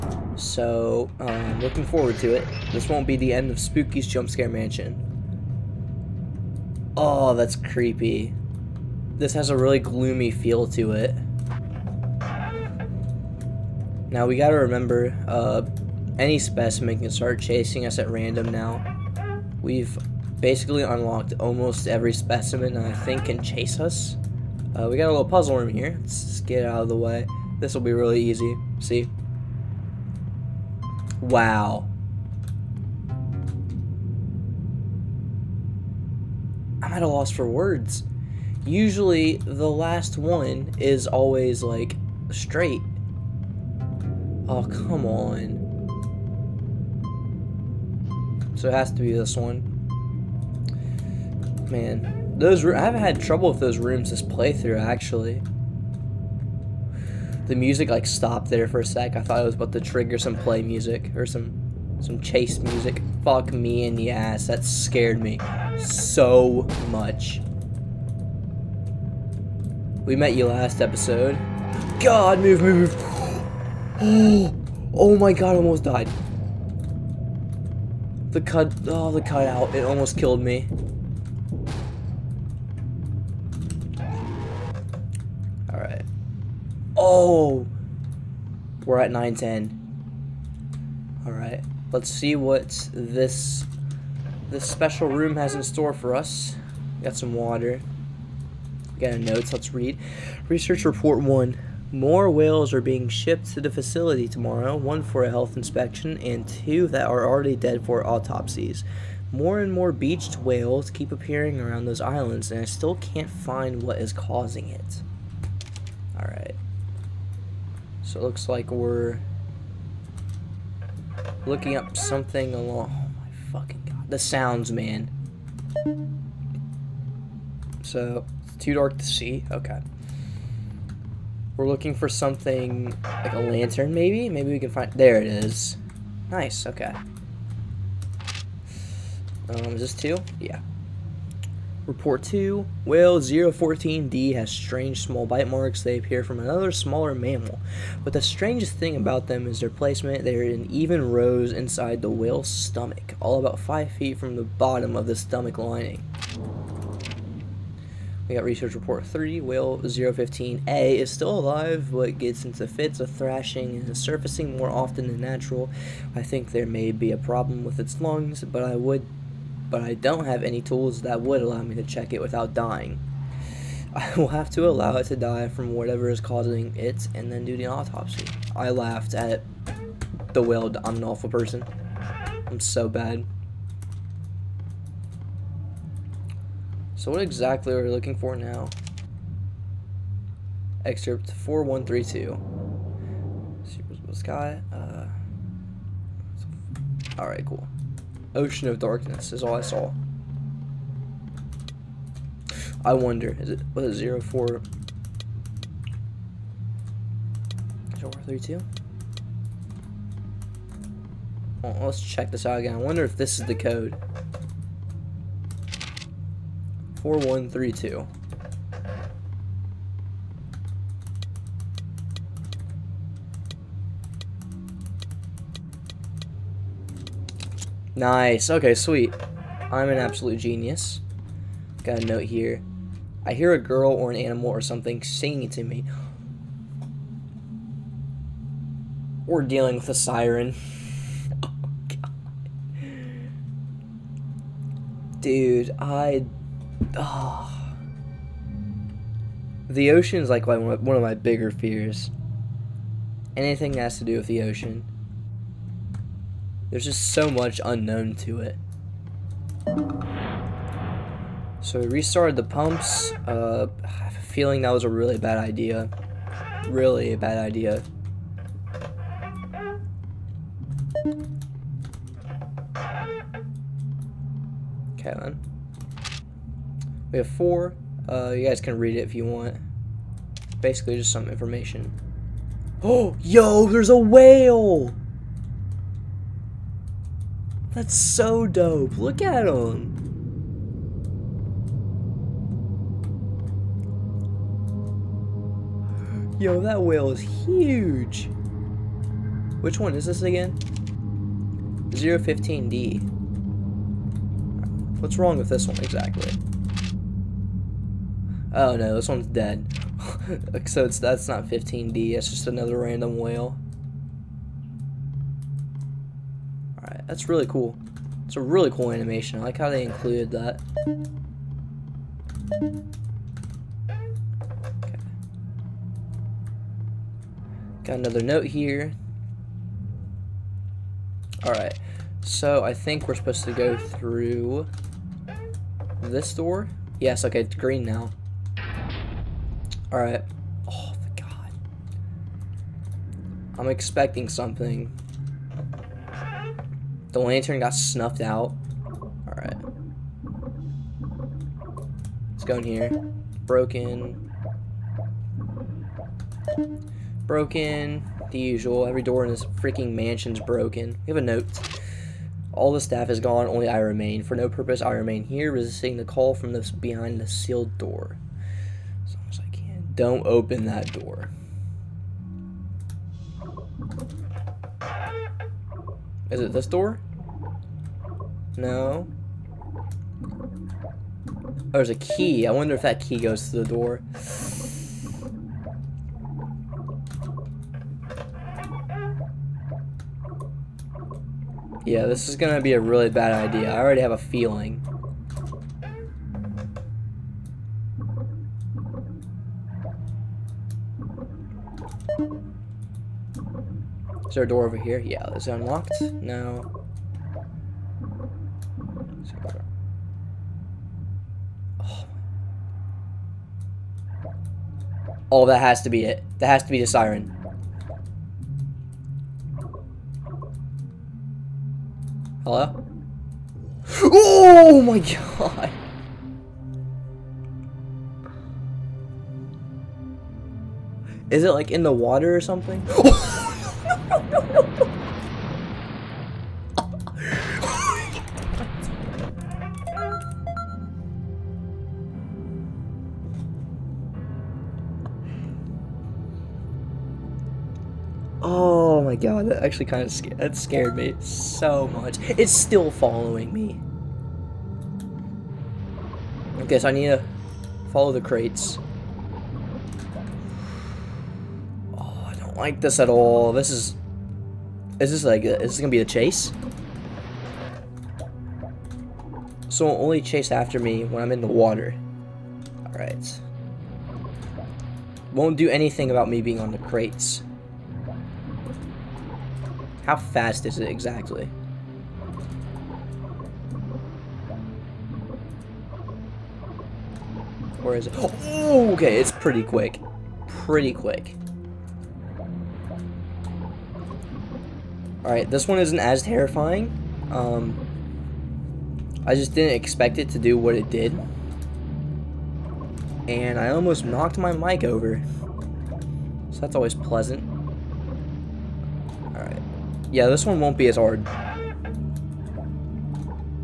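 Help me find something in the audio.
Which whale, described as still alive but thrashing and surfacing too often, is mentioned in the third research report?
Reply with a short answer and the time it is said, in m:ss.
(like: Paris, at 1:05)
015A, at 2:39.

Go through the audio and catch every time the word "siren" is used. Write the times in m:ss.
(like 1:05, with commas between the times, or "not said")
3:59, 6:56.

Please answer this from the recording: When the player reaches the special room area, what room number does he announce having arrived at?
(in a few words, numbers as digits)
910.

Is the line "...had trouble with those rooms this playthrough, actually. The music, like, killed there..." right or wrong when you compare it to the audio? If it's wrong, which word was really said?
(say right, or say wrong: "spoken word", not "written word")
wrong: "stopped", not "killed".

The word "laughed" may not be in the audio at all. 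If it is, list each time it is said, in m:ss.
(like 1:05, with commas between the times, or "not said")
2:58.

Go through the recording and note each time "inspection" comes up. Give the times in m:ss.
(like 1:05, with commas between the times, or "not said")
1:45.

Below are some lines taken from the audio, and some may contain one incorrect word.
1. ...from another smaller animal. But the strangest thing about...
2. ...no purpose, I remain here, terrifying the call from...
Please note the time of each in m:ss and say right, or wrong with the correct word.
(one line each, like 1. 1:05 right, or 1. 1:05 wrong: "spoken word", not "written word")
1. 2:26 wrong: "mammal", not "animal"
2. 6:04 wrong: "resisting", not "terrifying".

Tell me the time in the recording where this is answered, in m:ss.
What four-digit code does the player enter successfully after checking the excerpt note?
3:37.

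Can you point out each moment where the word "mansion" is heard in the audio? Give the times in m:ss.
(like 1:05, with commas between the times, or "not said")
0:04, 5:59.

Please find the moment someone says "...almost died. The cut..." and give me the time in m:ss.
1:15.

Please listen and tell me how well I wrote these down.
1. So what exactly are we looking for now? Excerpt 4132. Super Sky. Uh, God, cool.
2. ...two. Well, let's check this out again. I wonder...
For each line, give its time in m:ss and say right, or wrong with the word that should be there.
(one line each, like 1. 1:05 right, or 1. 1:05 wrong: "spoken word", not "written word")
1. 3:06 wrong: "Alright", not "God"
2. 3:28 right.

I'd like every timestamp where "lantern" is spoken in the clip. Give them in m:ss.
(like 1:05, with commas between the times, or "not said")
2:13, 5:47.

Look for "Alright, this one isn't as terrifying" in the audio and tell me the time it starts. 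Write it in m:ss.
8:15.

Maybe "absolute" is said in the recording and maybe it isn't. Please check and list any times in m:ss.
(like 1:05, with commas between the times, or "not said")
3:49.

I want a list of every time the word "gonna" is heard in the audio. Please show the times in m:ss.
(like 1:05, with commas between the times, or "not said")
6:32, 7:45.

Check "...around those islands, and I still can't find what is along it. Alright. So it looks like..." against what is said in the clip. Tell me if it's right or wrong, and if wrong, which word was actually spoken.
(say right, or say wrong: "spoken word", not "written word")
wrong: "causing", not "along".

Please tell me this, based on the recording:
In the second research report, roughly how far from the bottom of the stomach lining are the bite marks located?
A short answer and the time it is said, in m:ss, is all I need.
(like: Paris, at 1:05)
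5 feet, at 2:33.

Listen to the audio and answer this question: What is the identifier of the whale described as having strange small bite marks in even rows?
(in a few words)
014D.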